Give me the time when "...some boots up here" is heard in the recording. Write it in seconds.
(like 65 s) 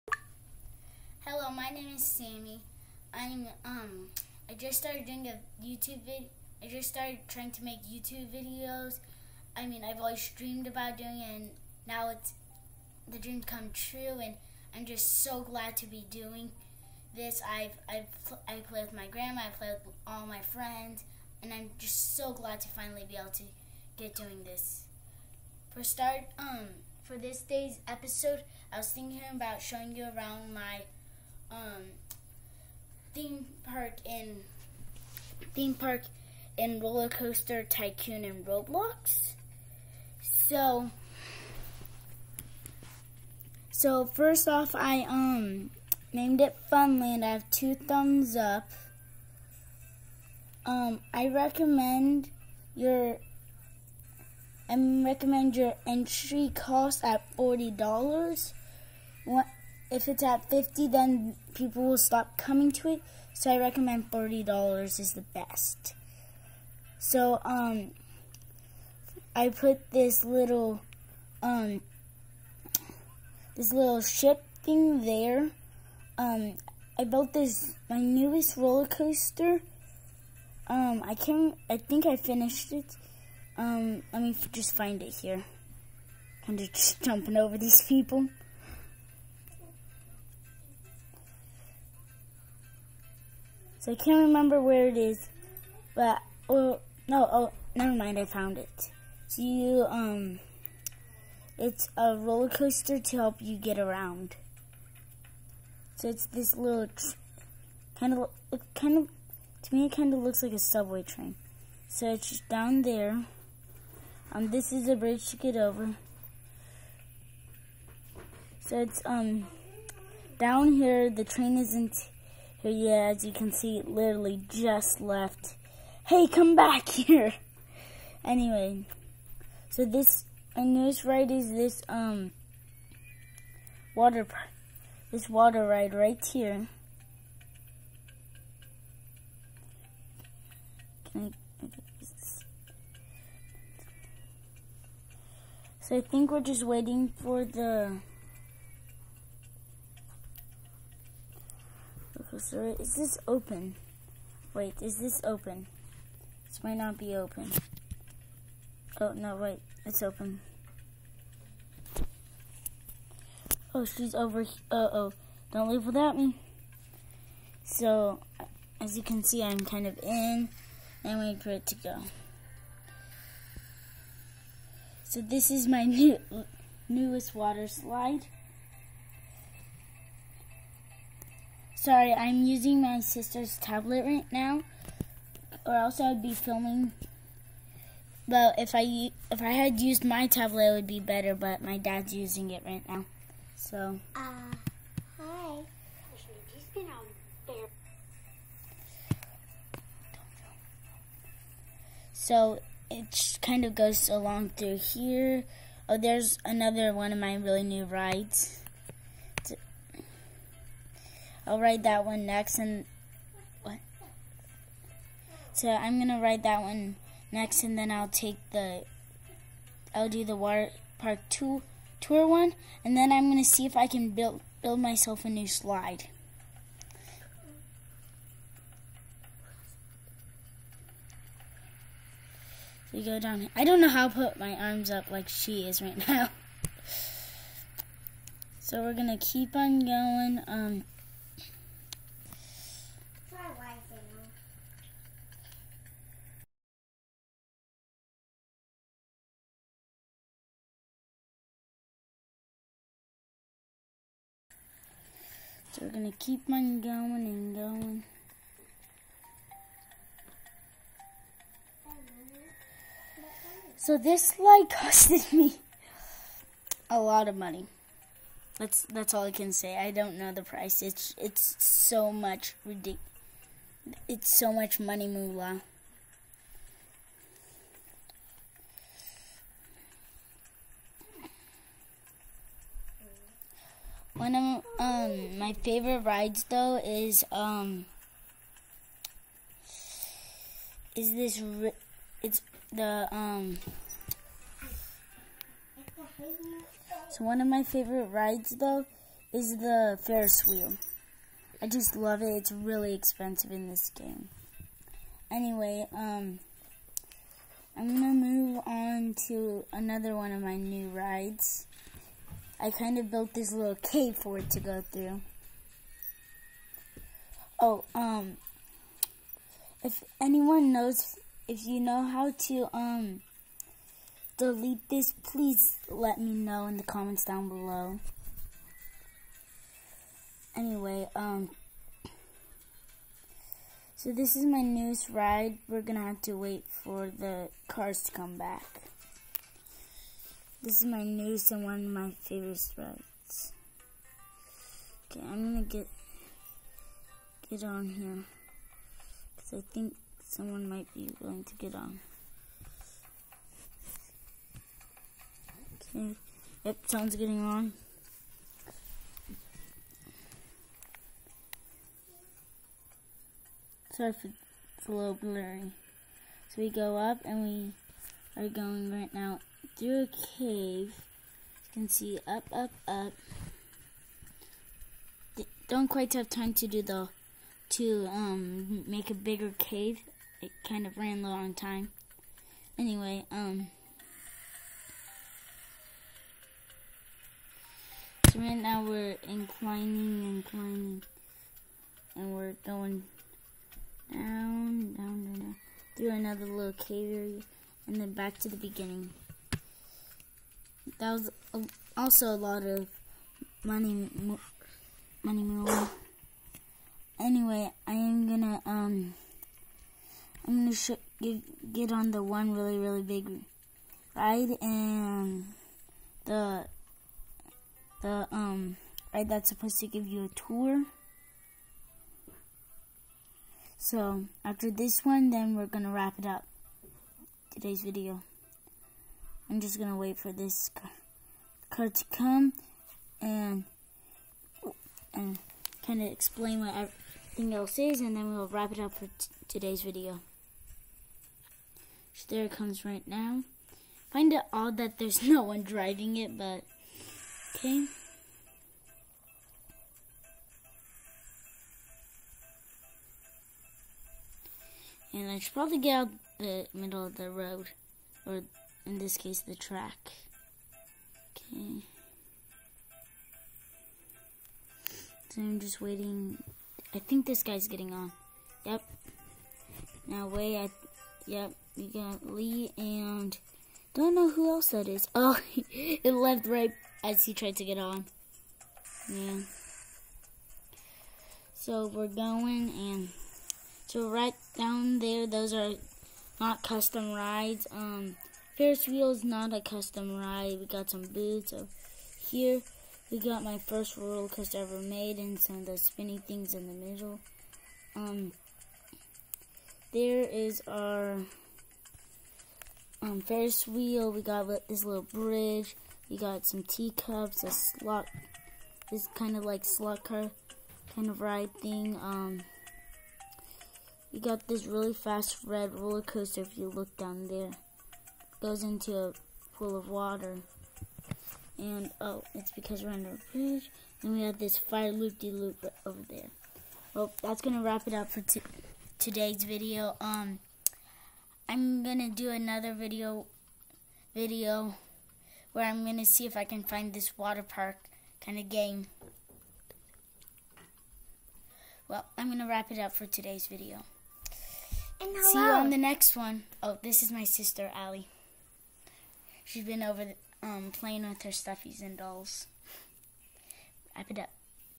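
490 s.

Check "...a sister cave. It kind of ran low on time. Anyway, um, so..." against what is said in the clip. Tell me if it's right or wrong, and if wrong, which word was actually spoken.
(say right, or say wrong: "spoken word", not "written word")
wrong: "bigger", not "sister".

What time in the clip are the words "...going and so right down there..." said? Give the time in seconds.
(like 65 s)
482 s.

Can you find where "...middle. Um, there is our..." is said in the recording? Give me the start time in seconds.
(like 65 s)
496 s.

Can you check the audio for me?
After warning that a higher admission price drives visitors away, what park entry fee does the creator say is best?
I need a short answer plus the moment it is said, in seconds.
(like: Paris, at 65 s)
$30, at 64 s.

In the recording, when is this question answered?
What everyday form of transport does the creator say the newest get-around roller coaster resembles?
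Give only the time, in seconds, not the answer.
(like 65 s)
110 s.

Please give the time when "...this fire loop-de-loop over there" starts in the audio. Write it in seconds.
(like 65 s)
524 s.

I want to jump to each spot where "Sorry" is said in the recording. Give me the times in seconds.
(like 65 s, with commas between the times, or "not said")
181 s, 363 s.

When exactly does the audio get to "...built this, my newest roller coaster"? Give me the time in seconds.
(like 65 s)
77 s.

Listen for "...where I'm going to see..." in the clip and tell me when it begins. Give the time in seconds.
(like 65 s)
535 s.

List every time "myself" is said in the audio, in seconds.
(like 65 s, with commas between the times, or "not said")
224 s.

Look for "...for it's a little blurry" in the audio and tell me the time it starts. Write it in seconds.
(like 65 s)
364 s.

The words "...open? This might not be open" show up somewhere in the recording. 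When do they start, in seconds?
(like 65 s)
155 s.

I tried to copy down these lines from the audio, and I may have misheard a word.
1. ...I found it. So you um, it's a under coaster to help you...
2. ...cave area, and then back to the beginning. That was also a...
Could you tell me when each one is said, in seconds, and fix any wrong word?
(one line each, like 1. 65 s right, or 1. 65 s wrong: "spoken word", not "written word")
1. 98 s wrong: "roller", not "under"
2. 396 s right.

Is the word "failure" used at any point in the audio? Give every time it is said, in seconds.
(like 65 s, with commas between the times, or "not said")
not said.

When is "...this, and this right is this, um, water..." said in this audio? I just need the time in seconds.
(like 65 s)
129 s.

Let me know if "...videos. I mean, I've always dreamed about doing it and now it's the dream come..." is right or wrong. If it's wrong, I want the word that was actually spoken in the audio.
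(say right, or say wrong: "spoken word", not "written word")
right.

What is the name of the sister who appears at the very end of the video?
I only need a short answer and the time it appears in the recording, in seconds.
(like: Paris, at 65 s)
Allie, at 547 s.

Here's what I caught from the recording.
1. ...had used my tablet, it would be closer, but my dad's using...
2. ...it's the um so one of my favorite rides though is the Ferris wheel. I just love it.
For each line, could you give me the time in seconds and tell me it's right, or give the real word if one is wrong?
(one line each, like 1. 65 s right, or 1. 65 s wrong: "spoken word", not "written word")
1. 189 s wrong: "better", not "closer"
2. 292 s right.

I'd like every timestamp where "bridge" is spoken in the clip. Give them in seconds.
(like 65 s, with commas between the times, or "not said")
114 s, 505 s, 523 s.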